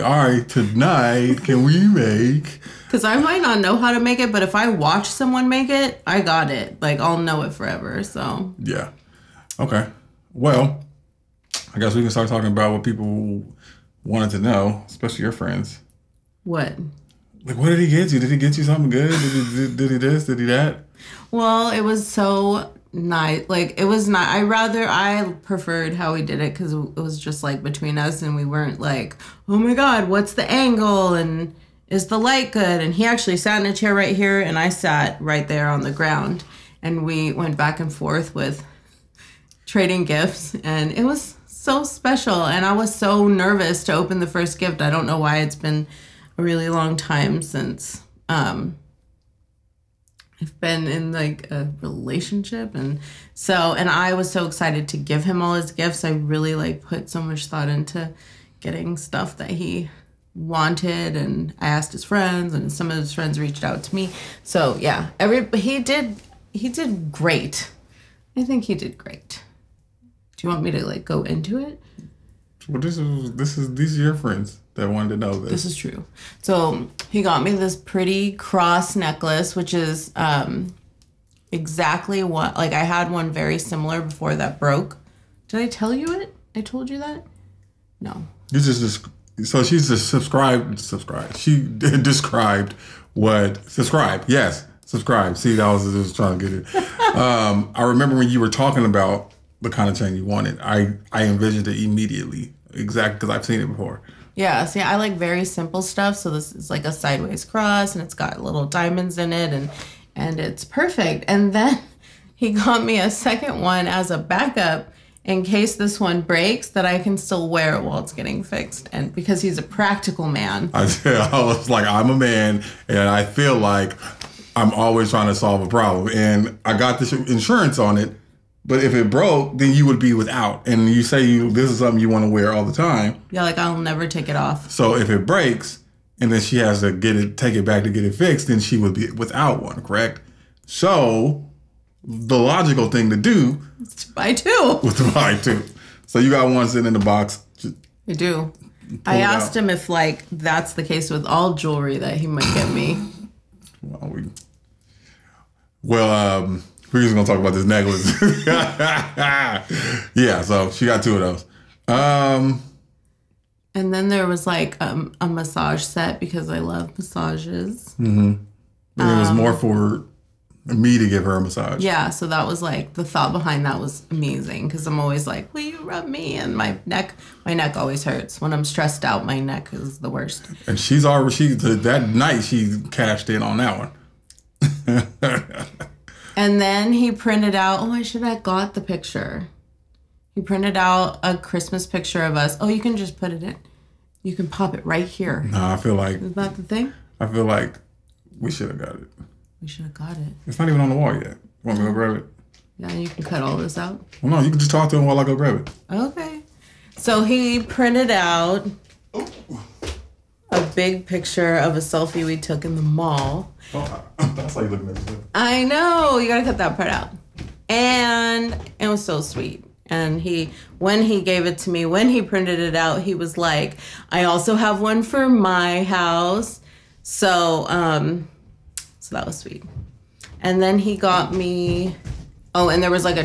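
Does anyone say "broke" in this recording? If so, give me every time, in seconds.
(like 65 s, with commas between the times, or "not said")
84 s, 129 s.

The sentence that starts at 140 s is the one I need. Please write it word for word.
So the logical thing to do is to buy two.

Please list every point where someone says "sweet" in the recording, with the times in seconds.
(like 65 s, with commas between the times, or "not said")
219 s, 229 s.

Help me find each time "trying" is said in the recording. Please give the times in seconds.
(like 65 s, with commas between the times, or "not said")
96 s, 125 s.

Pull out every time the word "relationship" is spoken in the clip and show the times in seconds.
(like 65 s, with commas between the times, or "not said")
51 s.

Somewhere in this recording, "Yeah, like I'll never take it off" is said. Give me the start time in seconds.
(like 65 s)
133 s.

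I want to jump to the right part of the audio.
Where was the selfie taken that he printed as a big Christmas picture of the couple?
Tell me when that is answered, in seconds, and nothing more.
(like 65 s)
212 s.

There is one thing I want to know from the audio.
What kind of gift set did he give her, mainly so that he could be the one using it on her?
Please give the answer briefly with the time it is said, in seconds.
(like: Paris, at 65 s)
Massage set, at 165 s.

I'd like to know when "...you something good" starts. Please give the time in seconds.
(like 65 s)
18 s.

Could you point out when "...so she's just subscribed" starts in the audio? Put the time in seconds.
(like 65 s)
89 s.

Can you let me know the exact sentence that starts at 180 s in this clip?
And she's already she that night she cashed in on that one.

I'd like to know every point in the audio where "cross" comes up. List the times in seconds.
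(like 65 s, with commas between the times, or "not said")
78 s, 107 s.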